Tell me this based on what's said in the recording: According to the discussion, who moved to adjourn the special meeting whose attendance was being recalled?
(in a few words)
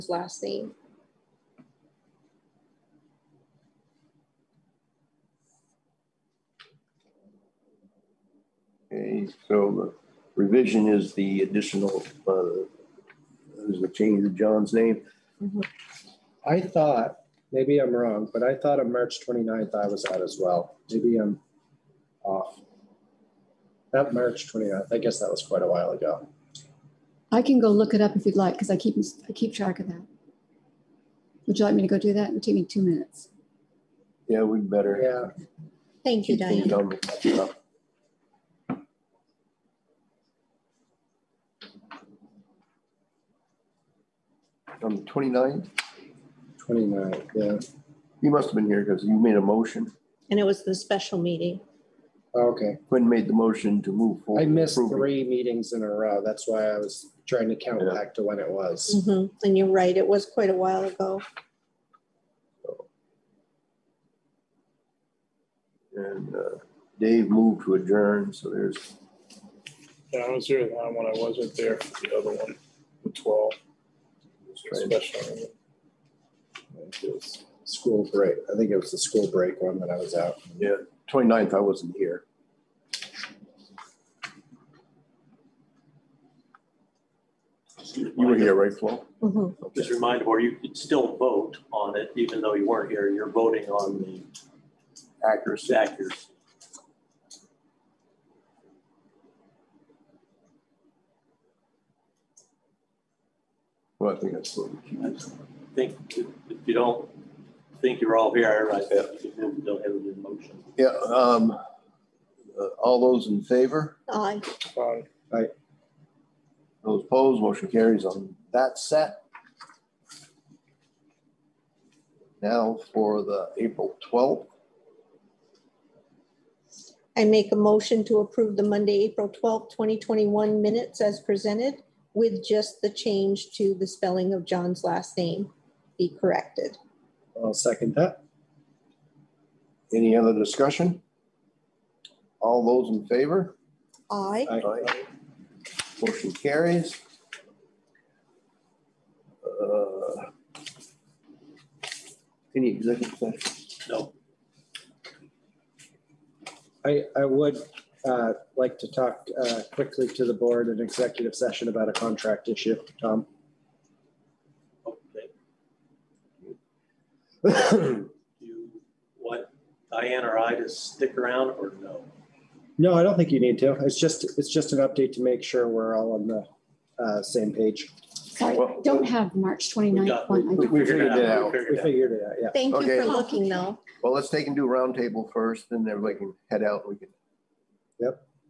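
Dave.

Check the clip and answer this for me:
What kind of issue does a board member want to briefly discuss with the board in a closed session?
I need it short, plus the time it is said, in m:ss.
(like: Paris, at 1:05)
A contract issue, at 2:41.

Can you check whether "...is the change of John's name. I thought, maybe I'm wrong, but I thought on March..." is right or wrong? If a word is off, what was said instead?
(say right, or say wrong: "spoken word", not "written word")
right.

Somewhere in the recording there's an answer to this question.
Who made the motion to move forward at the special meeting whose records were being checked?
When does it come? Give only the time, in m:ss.
0:52.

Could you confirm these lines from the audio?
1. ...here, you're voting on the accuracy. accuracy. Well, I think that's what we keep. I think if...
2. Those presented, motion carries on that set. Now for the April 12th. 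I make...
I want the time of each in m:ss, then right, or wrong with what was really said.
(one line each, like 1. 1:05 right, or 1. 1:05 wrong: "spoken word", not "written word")
1. 1:32 right
2. 1:56 wrong: "opposed", not "presented".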